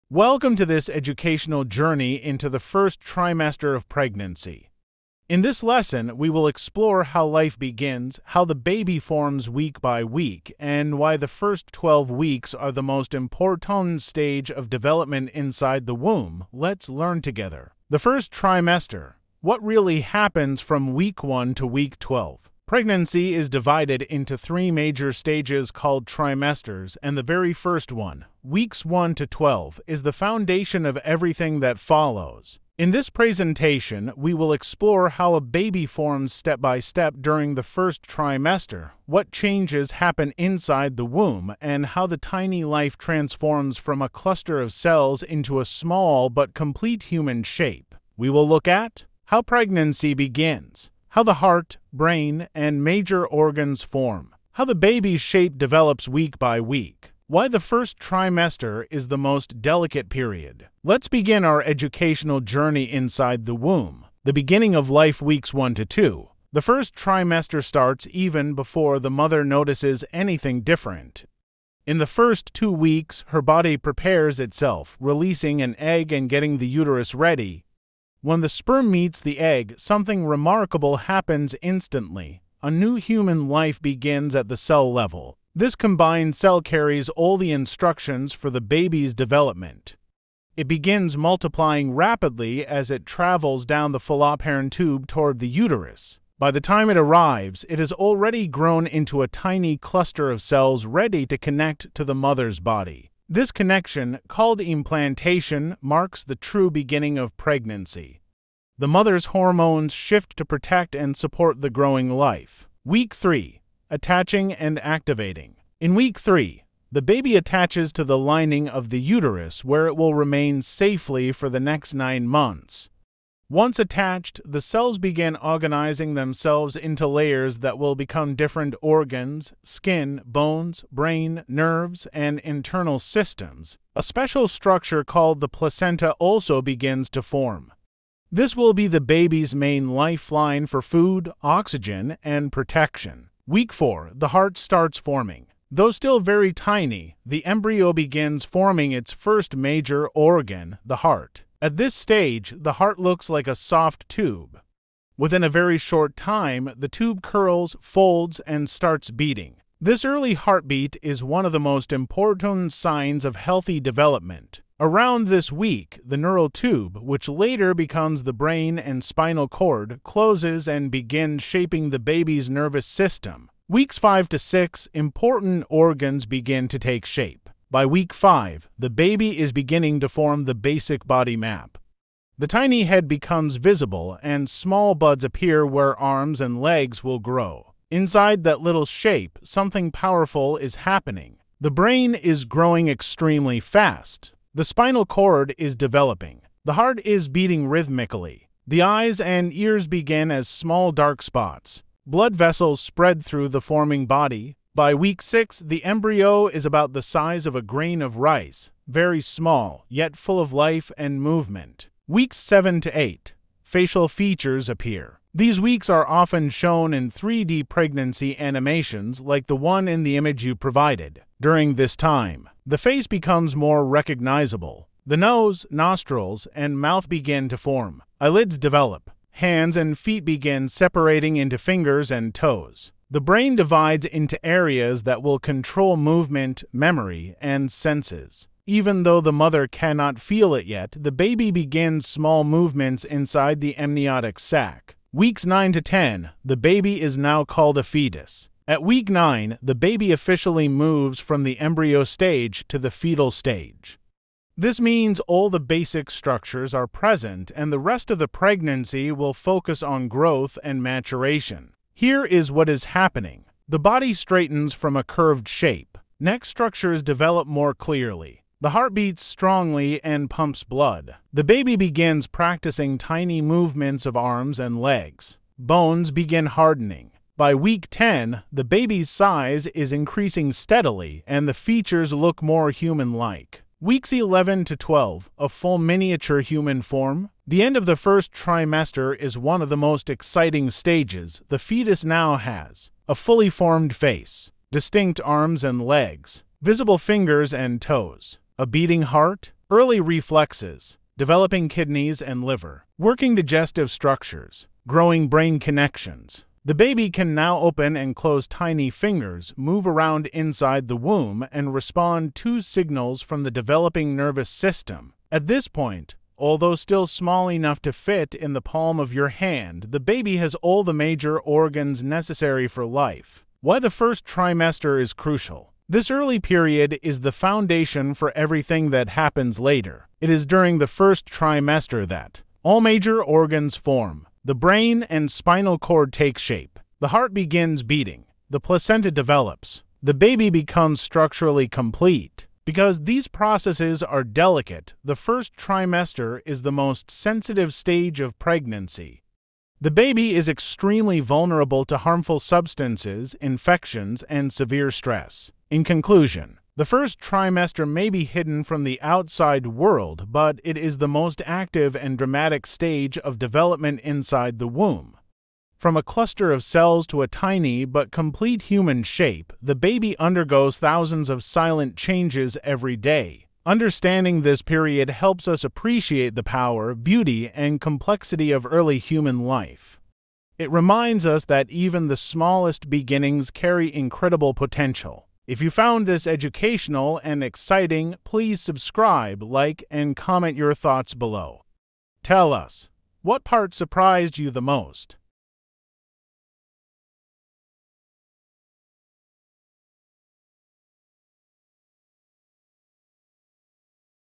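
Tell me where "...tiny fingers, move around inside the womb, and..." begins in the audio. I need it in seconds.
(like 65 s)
308 s.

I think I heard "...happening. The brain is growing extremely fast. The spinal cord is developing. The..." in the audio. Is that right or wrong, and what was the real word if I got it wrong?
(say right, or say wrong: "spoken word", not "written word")
right.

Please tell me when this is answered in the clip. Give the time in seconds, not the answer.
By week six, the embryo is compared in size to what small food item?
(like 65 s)
207 s.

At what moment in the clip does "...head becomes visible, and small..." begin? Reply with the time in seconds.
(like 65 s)
182 s.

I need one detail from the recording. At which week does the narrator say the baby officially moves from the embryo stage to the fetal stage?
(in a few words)
9.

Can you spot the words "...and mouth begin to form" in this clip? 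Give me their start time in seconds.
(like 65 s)
226 s.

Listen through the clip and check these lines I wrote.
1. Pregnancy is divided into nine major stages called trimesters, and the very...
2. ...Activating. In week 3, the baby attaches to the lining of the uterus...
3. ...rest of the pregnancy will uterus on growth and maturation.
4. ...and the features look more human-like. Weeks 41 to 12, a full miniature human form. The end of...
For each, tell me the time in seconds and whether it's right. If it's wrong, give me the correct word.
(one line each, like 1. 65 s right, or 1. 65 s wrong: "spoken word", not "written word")
1. 22 s wrong: "three", not "nine"
2. 114 s right
3. 257 s wrong: "focus", not "uterus"
4. 281 s wrong: "11", not "41".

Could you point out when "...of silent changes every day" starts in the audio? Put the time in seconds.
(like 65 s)
371 s.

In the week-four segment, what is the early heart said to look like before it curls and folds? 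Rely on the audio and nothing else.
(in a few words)
A soft tube.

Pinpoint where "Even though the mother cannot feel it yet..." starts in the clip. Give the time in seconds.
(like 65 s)
238 s.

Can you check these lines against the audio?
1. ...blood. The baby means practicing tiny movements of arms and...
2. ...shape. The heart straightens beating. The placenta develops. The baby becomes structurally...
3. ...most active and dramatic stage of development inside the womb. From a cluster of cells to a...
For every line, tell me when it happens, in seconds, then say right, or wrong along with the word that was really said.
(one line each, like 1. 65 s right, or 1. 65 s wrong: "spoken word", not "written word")
1. 270 s wrong: "begins", not "means"
2. 336 s wrong: "begins", not "straightens"
3. 361 s right.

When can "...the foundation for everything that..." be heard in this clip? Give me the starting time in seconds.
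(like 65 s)
327 s.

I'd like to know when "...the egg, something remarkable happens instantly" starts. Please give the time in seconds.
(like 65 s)
79 s.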